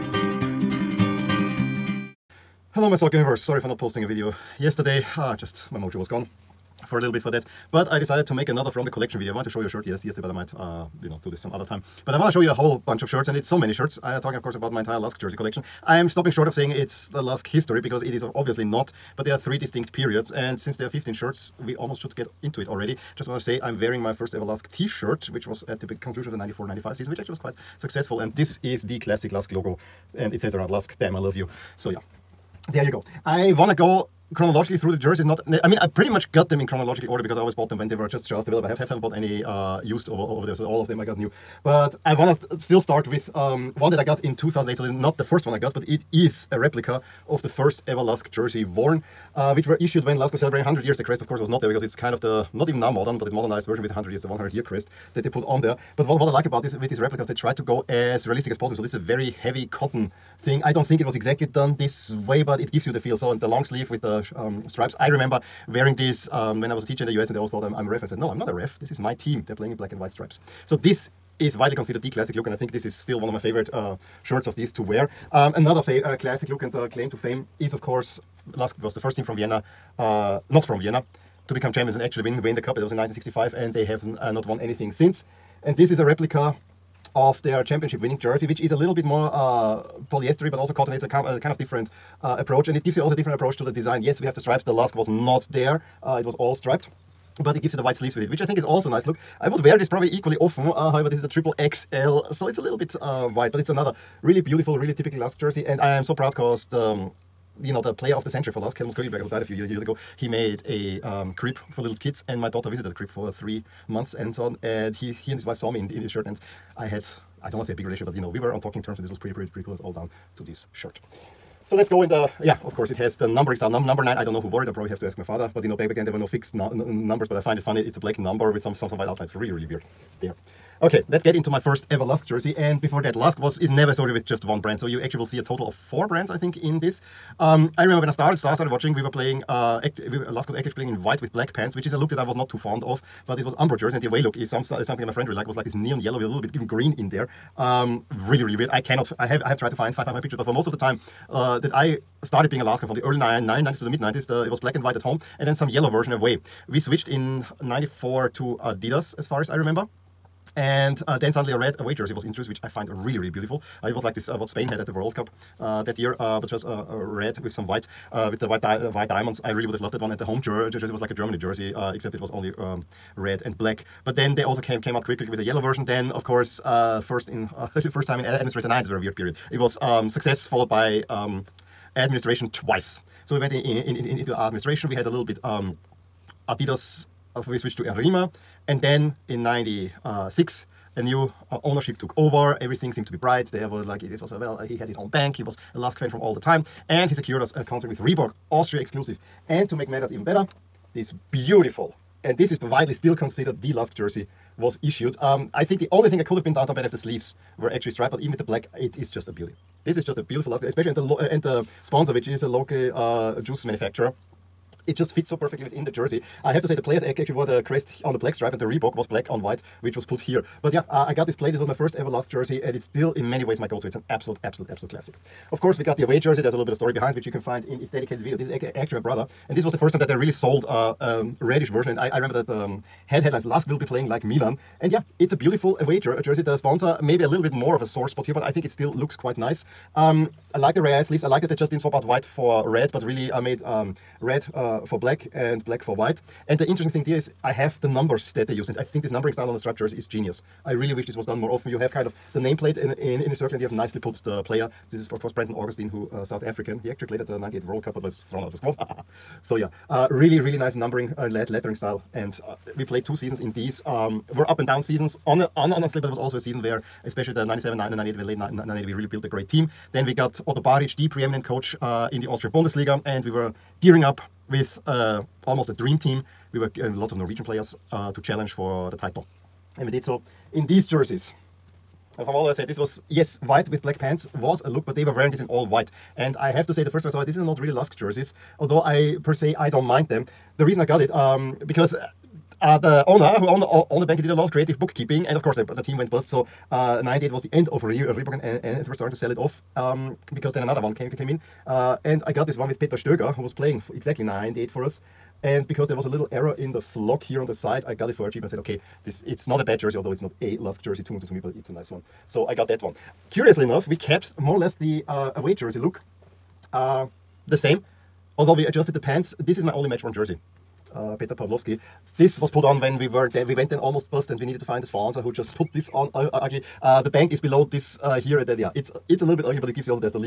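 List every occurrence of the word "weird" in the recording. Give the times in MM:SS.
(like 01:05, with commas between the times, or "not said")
02:09, 02:28, 02:58.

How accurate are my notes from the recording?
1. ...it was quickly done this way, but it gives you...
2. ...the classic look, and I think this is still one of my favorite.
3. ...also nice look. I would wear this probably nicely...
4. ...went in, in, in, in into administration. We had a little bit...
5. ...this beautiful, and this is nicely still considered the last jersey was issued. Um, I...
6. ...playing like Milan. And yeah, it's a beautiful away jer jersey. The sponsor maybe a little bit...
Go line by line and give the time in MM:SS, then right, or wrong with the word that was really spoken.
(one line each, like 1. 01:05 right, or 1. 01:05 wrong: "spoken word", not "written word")
1. 01:00 wrong: "exactly", not "quickly"
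2. 01:12 right
3. 01:38 wrong: "equally", not "nicely"
4. 03:03 right
5. 03:20 wrong: "widely", not "nicely"
6. 03:53 right.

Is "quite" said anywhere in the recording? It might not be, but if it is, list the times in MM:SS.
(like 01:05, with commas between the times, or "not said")
00:27, 03:59.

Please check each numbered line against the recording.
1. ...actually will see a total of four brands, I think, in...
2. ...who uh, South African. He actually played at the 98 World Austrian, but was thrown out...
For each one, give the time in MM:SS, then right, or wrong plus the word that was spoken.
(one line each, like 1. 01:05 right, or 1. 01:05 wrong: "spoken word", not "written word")
1. 02:15 right
2. 04:15 wrong: "Cup", not "Austrian".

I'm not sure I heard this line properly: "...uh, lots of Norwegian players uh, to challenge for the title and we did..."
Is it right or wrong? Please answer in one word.
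right.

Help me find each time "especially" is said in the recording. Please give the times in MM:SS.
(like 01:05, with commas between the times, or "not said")
03:30, 04:27.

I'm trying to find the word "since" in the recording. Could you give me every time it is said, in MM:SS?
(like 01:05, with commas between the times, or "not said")
00:20, 01:24.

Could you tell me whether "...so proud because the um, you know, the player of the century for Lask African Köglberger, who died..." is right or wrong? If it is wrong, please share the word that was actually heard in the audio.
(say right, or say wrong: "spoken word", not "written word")
wrong: "Helmut", not "African".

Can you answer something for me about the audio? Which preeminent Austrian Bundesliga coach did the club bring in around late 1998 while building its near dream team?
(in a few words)
Otto Baric.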